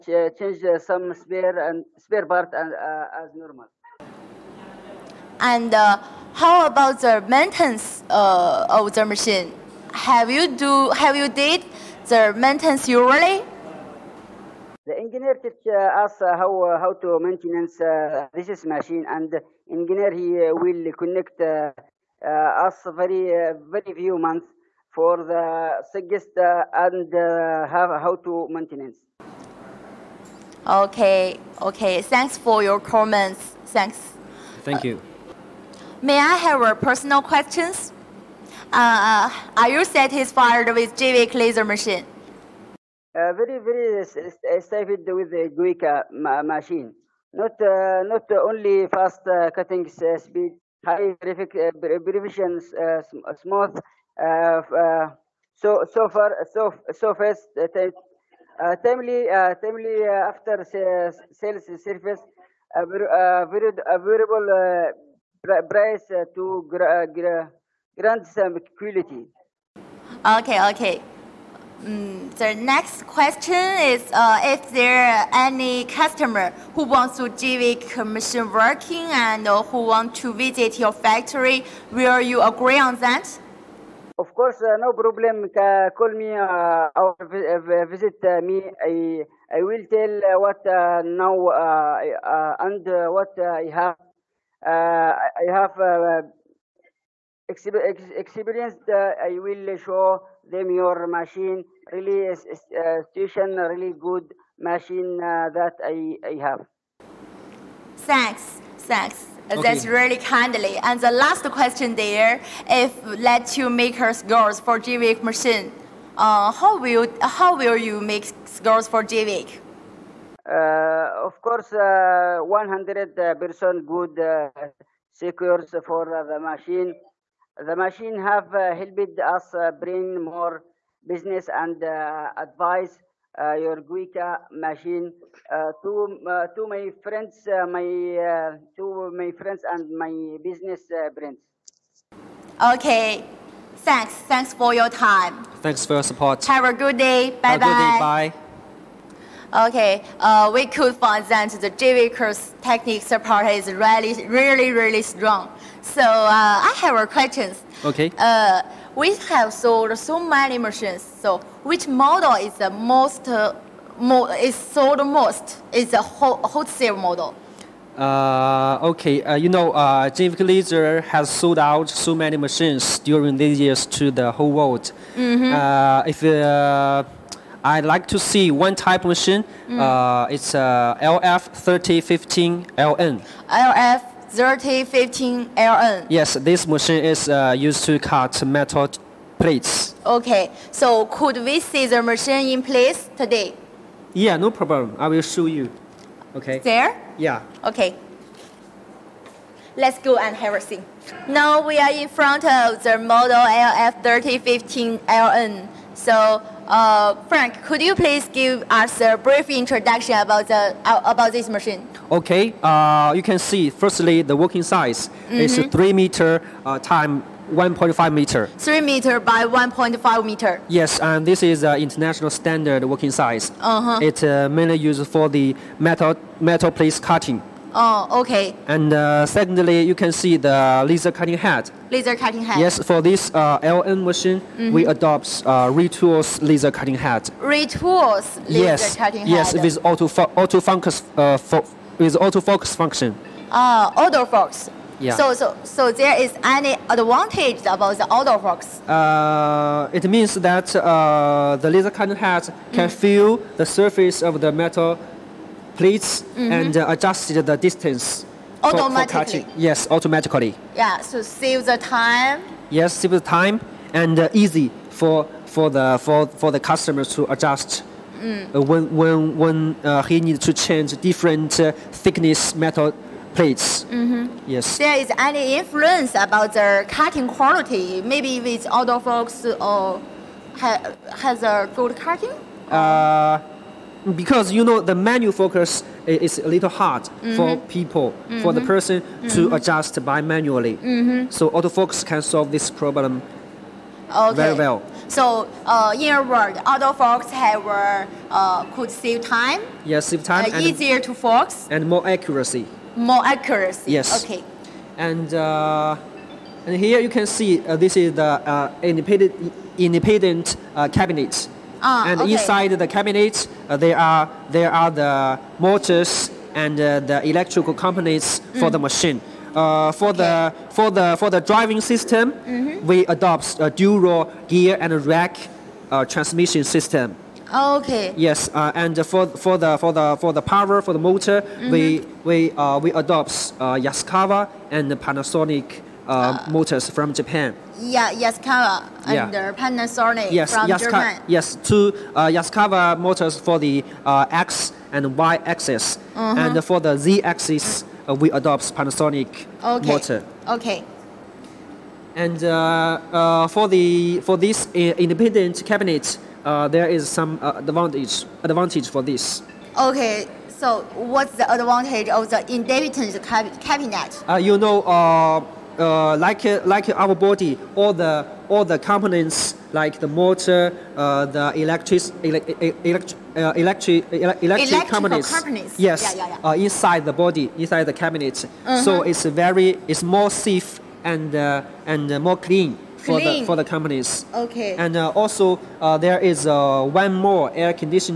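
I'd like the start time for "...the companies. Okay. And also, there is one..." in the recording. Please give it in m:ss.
6:23.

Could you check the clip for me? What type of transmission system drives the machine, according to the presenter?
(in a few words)
dual gear and rack.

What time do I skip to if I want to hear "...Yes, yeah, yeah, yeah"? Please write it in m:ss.
6:15.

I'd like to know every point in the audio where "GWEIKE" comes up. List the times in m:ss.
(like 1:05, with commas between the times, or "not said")
0:45, 1:54, 1:59, 2:13.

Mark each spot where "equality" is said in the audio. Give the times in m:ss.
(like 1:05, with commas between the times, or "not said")
1:08.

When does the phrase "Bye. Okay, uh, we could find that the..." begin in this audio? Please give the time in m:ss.
2:27.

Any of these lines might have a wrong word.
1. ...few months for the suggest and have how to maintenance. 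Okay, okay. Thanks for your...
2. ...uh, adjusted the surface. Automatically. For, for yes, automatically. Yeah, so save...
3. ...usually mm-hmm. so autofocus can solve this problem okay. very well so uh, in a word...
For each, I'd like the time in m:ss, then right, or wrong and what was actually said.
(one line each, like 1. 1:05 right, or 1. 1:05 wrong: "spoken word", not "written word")
1. 0:23 right
2. 4:16 wrong: "distance", not "surface"
3. 4:50 wrong: "manually", not "usually".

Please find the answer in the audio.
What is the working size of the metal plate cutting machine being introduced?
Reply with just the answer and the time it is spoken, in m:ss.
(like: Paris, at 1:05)
3 meter by 1.5 meter, at 3:38.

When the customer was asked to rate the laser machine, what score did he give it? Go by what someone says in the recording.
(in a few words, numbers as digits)
100 percent.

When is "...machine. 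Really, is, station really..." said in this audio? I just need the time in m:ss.
1:41.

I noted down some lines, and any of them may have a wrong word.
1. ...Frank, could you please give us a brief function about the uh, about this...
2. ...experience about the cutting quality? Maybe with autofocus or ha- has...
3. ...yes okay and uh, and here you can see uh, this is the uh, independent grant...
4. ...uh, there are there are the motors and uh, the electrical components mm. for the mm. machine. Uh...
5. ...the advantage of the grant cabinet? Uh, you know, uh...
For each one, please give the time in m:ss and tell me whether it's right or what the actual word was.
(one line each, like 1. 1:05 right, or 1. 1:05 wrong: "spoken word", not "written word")
1. 3:27 wrong: "introduction", not "function"
2. 4:35 wrong: "influence", not "experience"
3. 5:03 wrong: "independent", not "grant"
4. 5:13 right
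5. 6:01 wrong: "independent", not "grant".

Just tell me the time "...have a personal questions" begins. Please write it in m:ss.
0:36.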